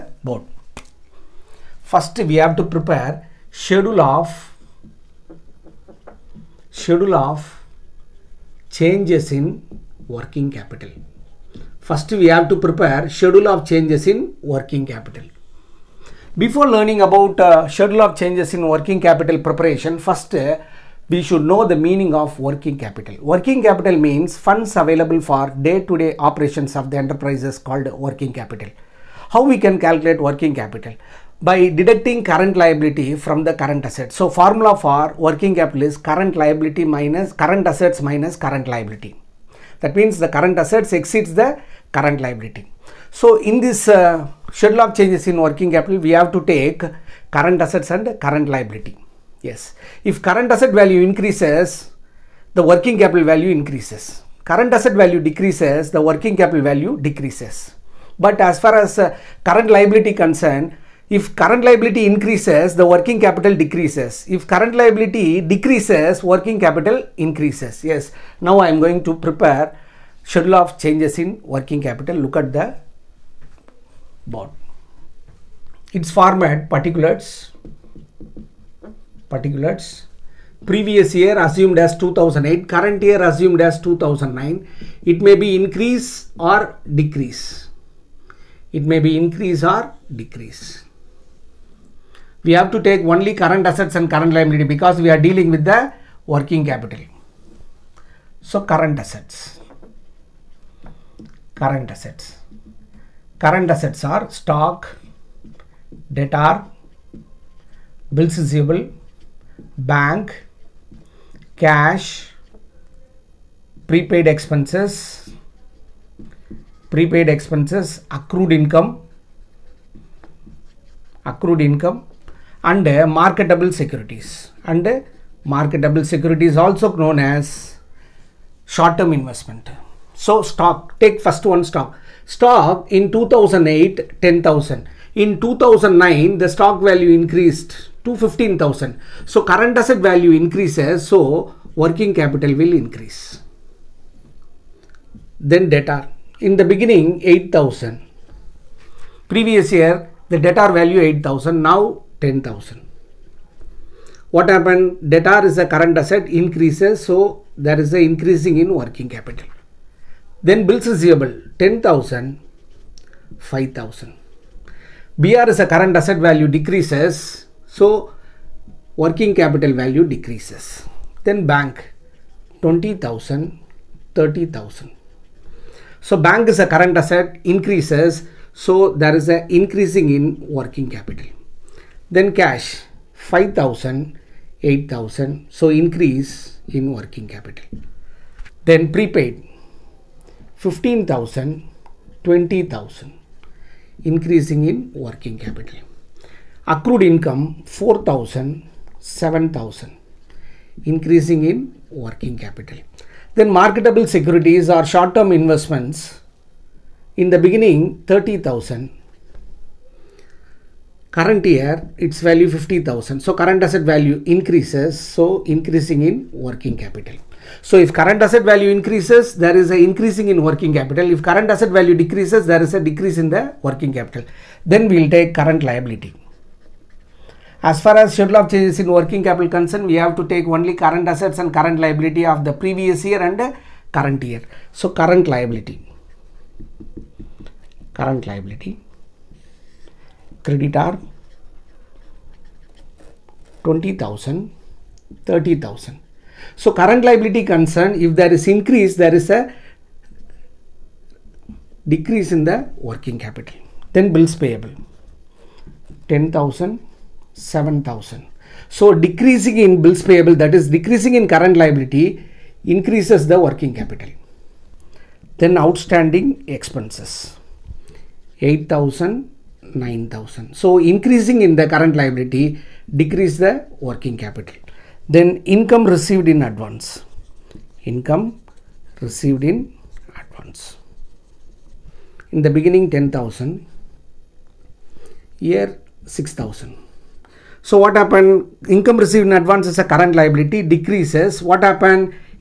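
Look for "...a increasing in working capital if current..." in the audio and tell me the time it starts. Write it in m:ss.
3:39.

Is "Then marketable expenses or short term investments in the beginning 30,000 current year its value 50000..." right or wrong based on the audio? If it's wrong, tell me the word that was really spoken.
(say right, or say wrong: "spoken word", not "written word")
wrong: "securities", not "expenses".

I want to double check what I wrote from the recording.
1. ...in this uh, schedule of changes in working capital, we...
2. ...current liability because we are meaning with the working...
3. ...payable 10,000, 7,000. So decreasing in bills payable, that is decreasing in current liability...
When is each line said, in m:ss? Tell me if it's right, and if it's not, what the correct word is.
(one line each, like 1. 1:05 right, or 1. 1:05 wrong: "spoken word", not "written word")
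1. 0:43 right
2. 1:34 wrong: "dealing", not "meaning"
3. 4:14 right.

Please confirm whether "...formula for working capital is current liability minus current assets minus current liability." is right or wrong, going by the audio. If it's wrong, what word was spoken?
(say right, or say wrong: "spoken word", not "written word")
right.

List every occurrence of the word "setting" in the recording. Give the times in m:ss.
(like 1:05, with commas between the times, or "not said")
not said.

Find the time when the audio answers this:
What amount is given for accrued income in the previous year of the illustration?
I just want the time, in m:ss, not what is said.
3:17.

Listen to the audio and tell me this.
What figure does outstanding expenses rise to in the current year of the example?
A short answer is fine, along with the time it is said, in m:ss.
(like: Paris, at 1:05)
9,000, at 4:29.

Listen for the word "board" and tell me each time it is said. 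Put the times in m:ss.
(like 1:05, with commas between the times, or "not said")
0:00, 1:14.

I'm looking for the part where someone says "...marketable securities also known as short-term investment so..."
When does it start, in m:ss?
2:05.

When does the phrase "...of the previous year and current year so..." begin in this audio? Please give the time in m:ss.
3:52.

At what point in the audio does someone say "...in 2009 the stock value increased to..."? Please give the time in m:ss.
2:15.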